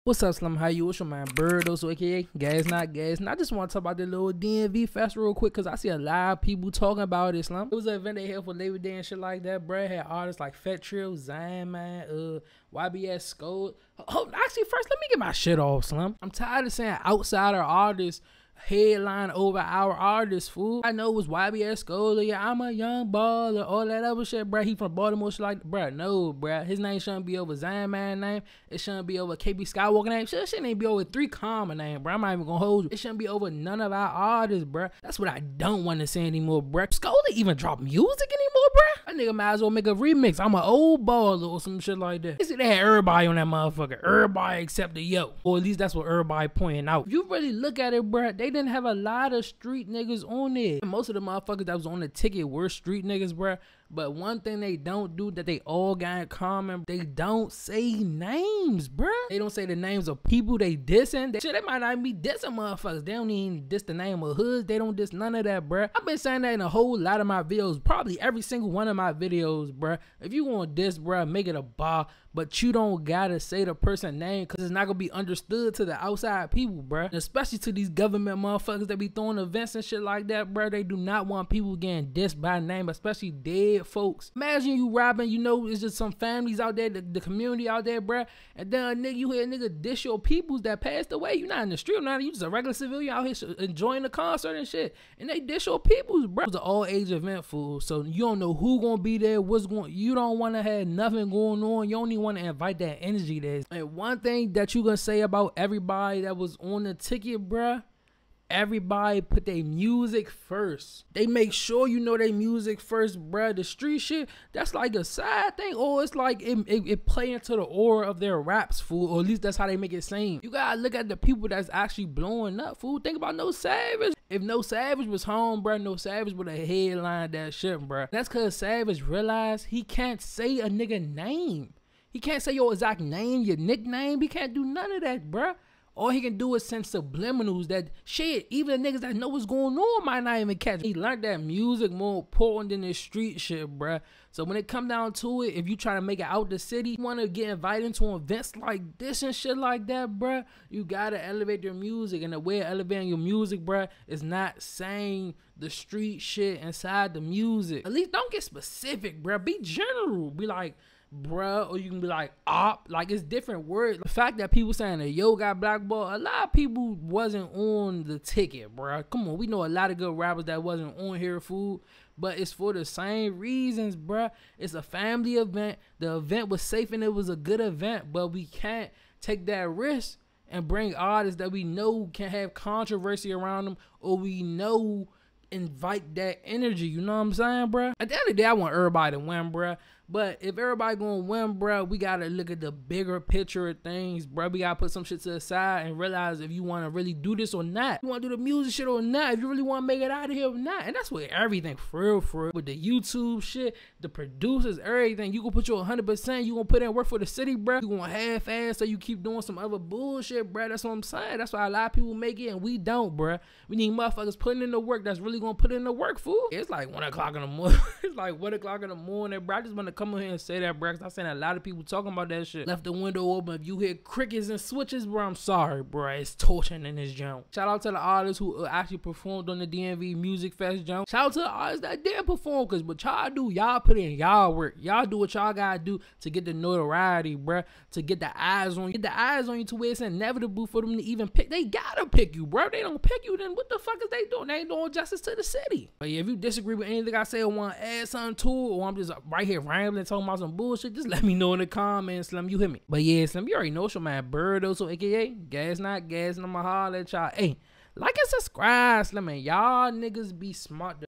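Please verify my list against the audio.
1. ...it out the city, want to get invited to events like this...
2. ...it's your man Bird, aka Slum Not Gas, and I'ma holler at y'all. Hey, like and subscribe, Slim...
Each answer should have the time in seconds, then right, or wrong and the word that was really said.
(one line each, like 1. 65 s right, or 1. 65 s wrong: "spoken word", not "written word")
1. 146 s right
2. 253 s wrong: "Gas", not "Slum".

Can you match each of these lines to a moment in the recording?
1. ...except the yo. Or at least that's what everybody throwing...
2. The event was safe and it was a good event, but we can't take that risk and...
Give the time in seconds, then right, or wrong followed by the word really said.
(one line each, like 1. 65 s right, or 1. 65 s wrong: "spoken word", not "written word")
1. 44 s wrong: "pointing", not "throwing"
2. 175 s right.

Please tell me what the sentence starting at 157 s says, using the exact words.
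At least don't get specific, bruh.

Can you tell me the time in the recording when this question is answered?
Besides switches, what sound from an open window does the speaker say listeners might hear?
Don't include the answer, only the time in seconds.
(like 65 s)
223 s.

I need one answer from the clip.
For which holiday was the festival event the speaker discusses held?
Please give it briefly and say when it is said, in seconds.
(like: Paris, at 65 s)
Labor Day, at 8 s.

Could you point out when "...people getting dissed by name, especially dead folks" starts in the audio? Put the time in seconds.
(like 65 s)
81 s.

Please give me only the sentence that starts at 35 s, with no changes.
That's what I don't want to say anymore, bruh.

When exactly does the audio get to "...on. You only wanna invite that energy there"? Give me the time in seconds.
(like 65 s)
101 s.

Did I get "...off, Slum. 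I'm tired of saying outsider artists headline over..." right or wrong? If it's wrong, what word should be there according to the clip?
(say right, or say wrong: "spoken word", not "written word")
right.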